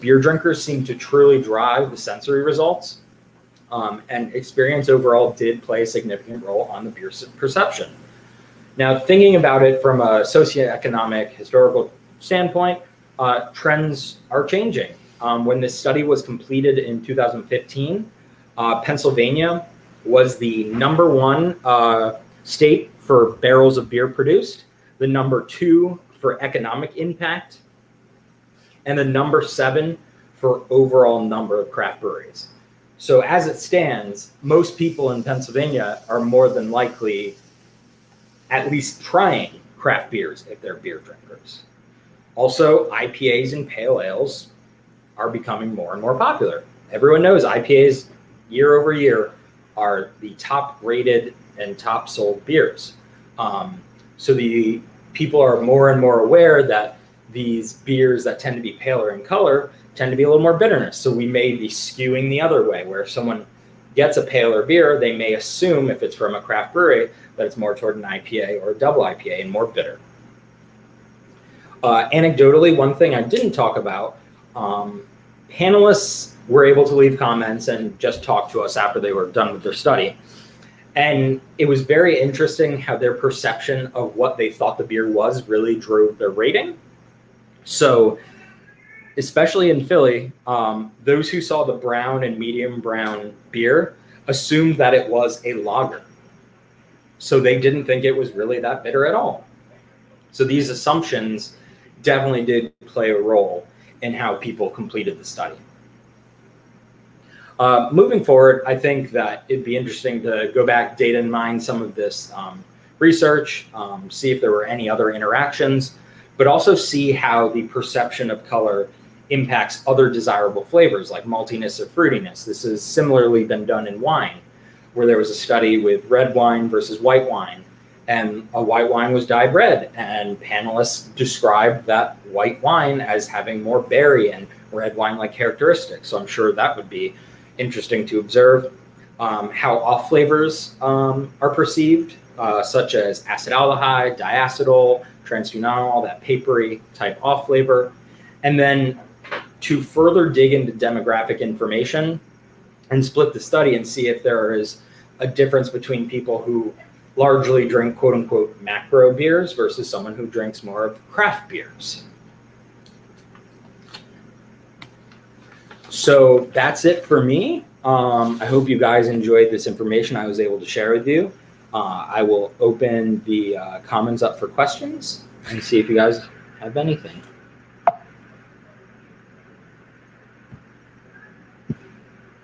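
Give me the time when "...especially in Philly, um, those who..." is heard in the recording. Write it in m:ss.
1:29.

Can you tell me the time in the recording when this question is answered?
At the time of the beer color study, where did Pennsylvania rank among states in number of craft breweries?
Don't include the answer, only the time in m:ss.
0:29.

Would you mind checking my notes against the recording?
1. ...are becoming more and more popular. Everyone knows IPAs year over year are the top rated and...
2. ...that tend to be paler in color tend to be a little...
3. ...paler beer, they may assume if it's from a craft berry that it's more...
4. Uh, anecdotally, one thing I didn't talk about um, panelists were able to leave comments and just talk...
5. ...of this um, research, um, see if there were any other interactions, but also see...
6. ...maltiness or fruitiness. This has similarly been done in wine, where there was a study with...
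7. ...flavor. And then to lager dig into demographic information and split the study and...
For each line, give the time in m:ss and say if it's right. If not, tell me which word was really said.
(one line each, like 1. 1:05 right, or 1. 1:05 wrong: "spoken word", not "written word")
1. 0:45 right
2. 0:58 right
3. 1:04 wrong: "brewery", not "berry"
4. 1:11 right
5. 1:51 right
6. 2:01 right
7. 2:27 wrong: "further", not "lager".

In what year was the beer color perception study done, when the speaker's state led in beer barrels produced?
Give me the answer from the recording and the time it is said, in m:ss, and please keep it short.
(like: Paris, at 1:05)
2015, at 0:17.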